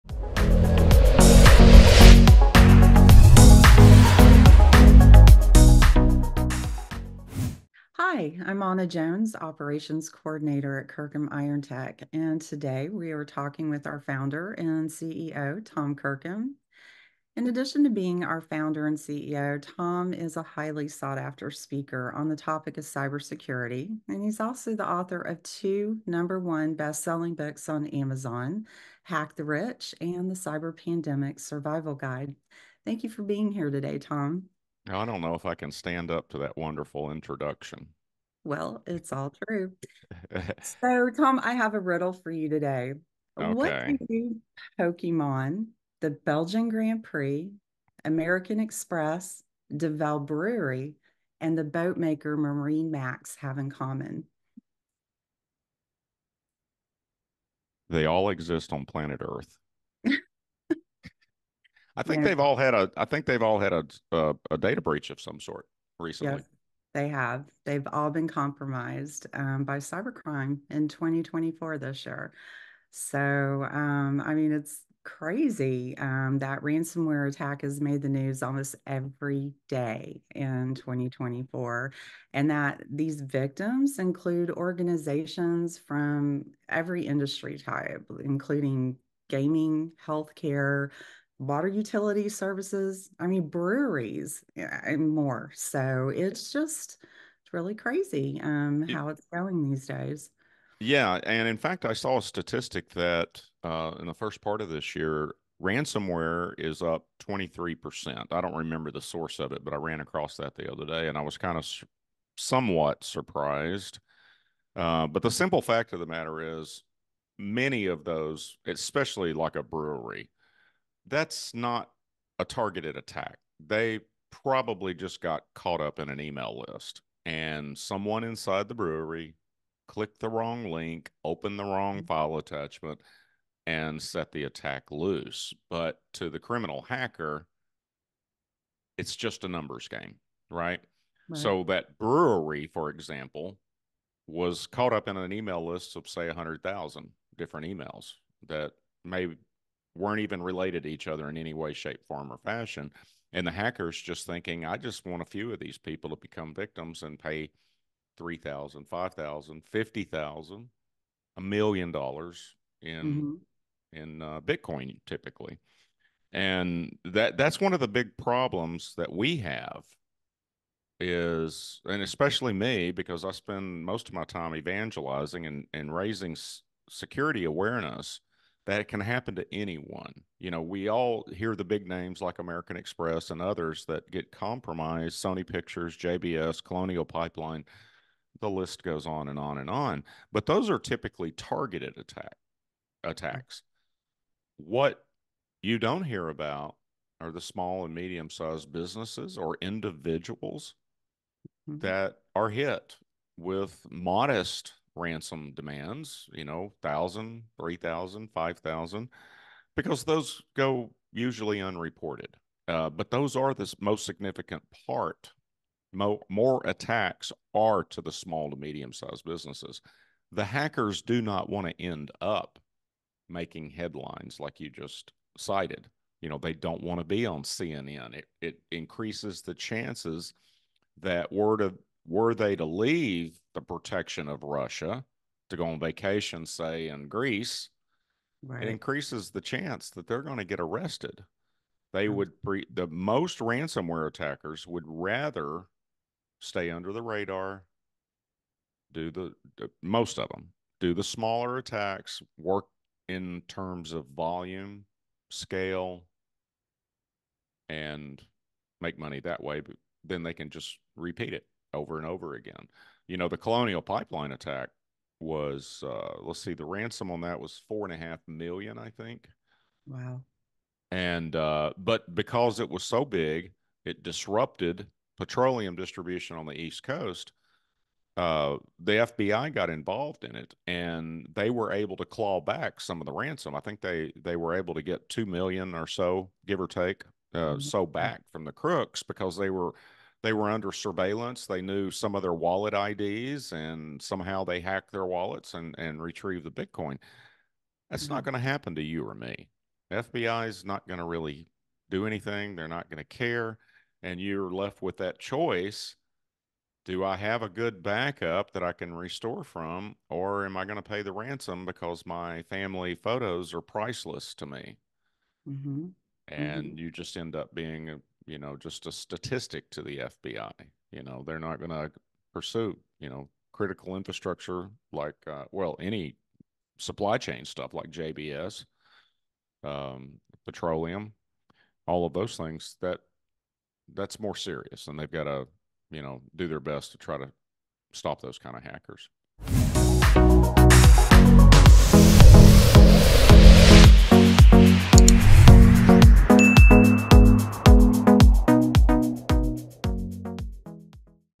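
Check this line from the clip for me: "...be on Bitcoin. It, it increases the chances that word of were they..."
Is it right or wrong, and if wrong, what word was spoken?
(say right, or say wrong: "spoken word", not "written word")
wrong: "CNN", not "Bitcoin".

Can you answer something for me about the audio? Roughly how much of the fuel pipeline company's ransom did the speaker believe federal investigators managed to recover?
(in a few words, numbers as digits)
2 million.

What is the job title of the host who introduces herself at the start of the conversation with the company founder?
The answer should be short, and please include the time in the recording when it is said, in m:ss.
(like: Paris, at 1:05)
Operations Coordinator, at 0:09.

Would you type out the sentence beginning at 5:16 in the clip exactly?
you just end up being you know, just a statistic to the FBI.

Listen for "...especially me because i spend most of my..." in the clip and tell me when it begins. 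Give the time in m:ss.
2:52.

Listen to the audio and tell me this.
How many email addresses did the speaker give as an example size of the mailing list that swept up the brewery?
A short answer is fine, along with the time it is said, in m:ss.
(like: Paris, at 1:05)
100,000, at 2:26.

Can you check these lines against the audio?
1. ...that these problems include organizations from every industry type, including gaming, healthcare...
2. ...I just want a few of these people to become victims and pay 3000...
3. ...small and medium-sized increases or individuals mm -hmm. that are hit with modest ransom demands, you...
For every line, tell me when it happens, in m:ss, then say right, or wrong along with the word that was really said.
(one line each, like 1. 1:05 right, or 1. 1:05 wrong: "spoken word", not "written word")
1. 1:22 wrong: "victims", not "problems"
2. 2:34 right
3. 3:17 wrong: "businesses", not "increases".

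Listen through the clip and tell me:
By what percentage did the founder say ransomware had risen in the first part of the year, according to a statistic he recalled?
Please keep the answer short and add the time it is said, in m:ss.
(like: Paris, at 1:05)
23%, at 1:47.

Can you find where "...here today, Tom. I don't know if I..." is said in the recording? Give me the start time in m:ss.
0:33.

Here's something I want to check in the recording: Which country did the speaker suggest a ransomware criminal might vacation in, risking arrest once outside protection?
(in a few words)
Greece.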